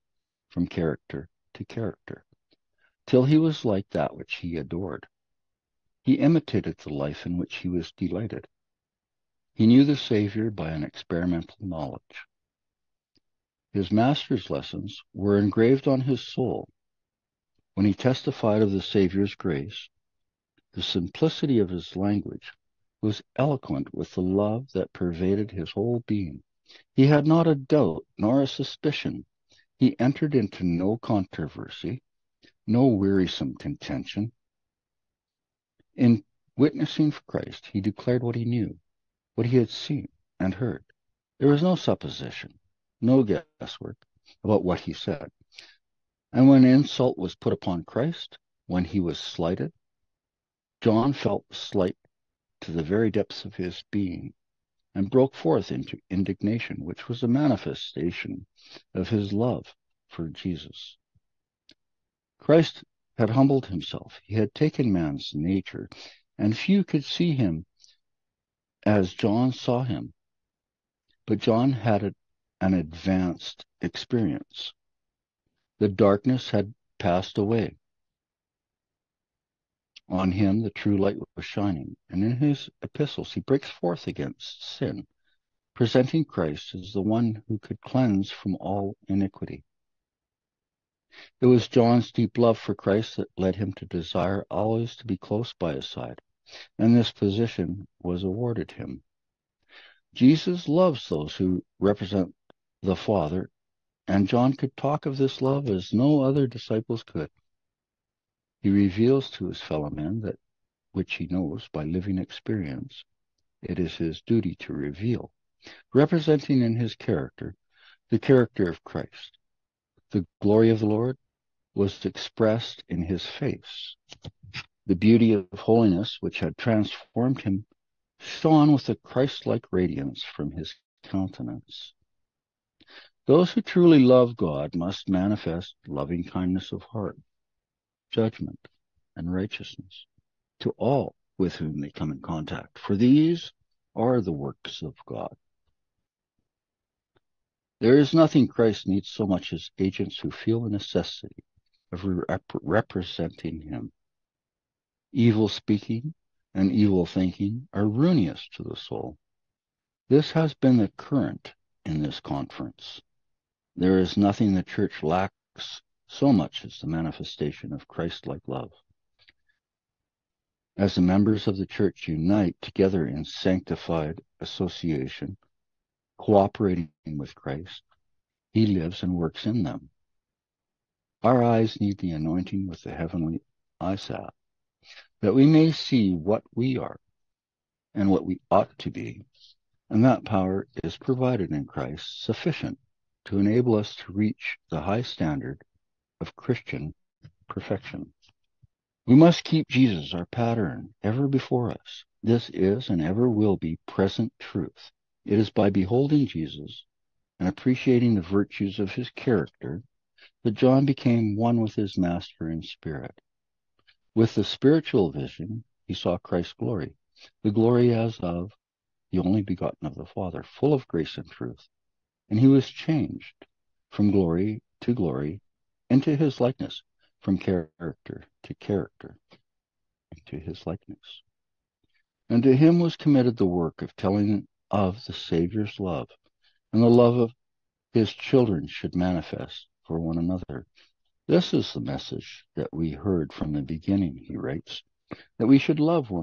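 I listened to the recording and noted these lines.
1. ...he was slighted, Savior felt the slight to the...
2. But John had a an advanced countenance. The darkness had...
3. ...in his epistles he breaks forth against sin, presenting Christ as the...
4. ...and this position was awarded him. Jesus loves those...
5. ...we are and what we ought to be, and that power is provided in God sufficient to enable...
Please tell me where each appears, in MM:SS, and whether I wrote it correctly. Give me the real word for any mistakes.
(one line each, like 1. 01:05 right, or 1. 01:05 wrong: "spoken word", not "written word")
1. 00:48 wrong: "John", not "Savior"
2. 01:11 wrong: "experience", not "countenance"
3. 01:22 right
4. 01:36 right
5. 03:06 wrong: "Christ", not "God".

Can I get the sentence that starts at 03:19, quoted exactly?
We must keep Jesus, our pattern, ever before us.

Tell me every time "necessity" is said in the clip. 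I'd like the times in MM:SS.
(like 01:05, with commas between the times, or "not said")
02:30.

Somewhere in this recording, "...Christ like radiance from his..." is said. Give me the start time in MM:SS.
02:08.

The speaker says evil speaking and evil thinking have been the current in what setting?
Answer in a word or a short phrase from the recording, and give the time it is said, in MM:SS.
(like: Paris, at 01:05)
this conference, at 02:42.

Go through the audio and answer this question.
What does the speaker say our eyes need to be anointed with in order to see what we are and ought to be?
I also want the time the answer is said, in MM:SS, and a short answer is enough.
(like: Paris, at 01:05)
heavenly eyesight, at 03:02.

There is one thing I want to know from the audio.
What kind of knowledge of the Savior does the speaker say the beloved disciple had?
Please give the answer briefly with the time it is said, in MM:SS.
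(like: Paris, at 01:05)
experimental knowledge, at 00:10.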